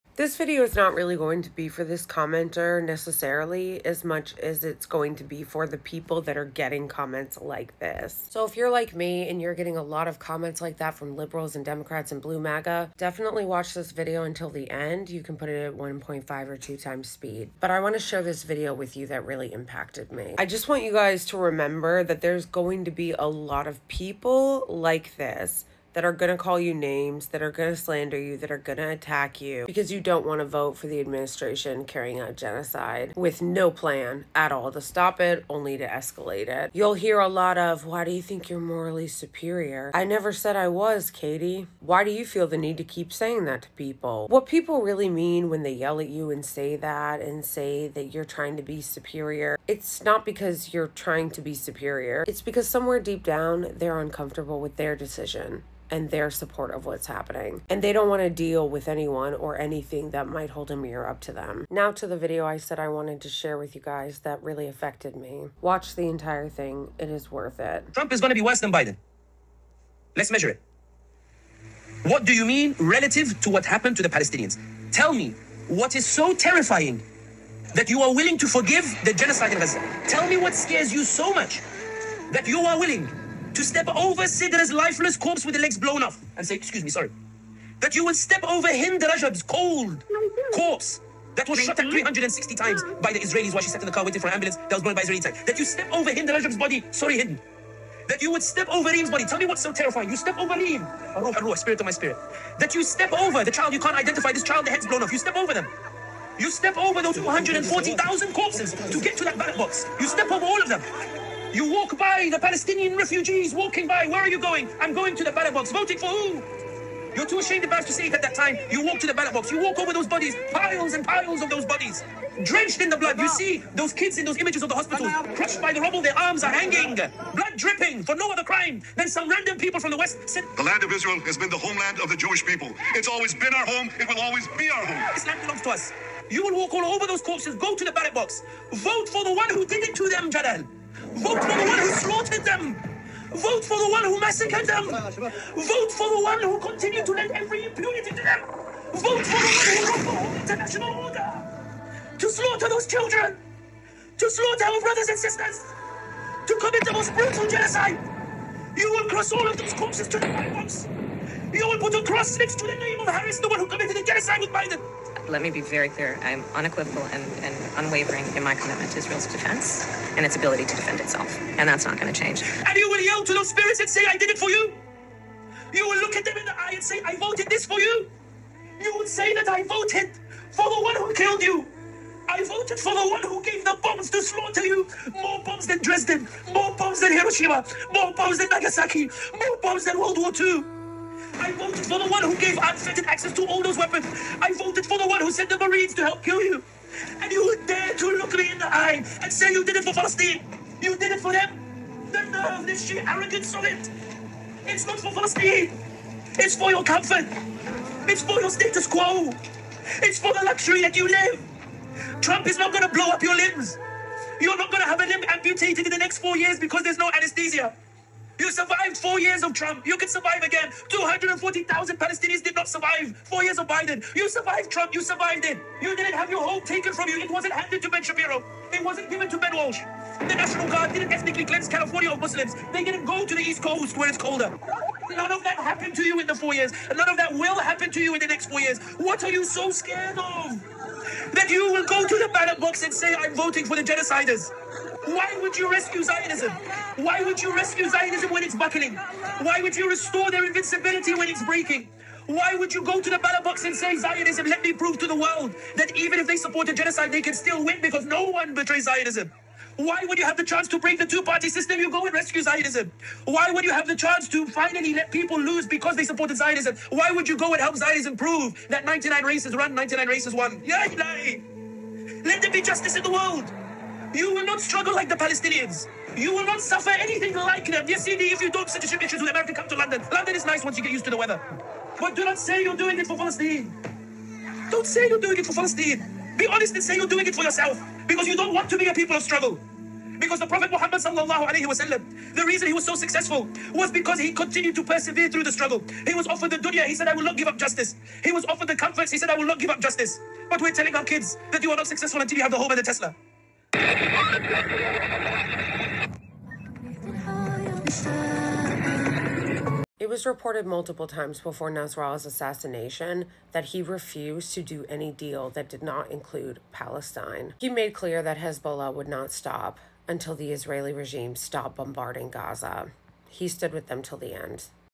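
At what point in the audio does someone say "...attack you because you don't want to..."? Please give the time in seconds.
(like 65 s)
28 s.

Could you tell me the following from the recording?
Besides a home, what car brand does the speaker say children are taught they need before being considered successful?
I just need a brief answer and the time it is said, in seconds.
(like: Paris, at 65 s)
Tesla, at 302 s.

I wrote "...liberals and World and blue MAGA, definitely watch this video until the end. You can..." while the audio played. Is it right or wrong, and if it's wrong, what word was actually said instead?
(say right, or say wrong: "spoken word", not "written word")
wrong: "Democrats", not "World".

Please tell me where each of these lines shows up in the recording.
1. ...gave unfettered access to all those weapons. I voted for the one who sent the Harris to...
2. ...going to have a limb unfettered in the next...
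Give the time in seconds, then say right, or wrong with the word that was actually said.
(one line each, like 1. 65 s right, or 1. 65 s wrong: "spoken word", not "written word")
1. 192 s wrong: "Marines", not "Harris"
2. 214 s wrong: "amputated", not "unfettered".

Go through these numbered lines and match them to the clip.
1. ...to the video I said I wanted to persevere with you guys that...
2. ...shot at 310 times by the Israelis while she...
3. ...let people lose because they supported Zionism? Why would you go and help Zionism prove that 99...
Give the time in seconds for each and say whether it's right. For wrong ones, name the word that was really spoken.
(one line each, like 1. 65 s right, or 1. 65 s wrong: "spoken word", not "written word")
1. 61 s wrong: "share", not "persevere"
2. 91 s wrong: "360", not "310"
3. 264 s right.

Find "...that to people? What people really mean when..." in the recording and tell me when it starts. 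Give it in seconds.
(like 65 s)
43 s.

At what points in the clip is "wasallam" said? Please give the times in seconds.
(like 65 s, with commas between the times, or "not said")
291 s.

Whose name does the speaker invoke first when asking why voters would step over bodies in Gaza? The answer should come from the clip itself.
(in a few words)
Sidra.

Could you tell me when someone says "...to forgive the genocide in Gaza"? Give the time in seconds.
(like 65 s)
78 s.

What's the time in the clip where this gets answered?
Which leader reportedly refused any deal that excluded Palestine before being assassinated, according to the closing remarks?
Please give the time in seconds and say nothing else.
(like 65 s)
311 s.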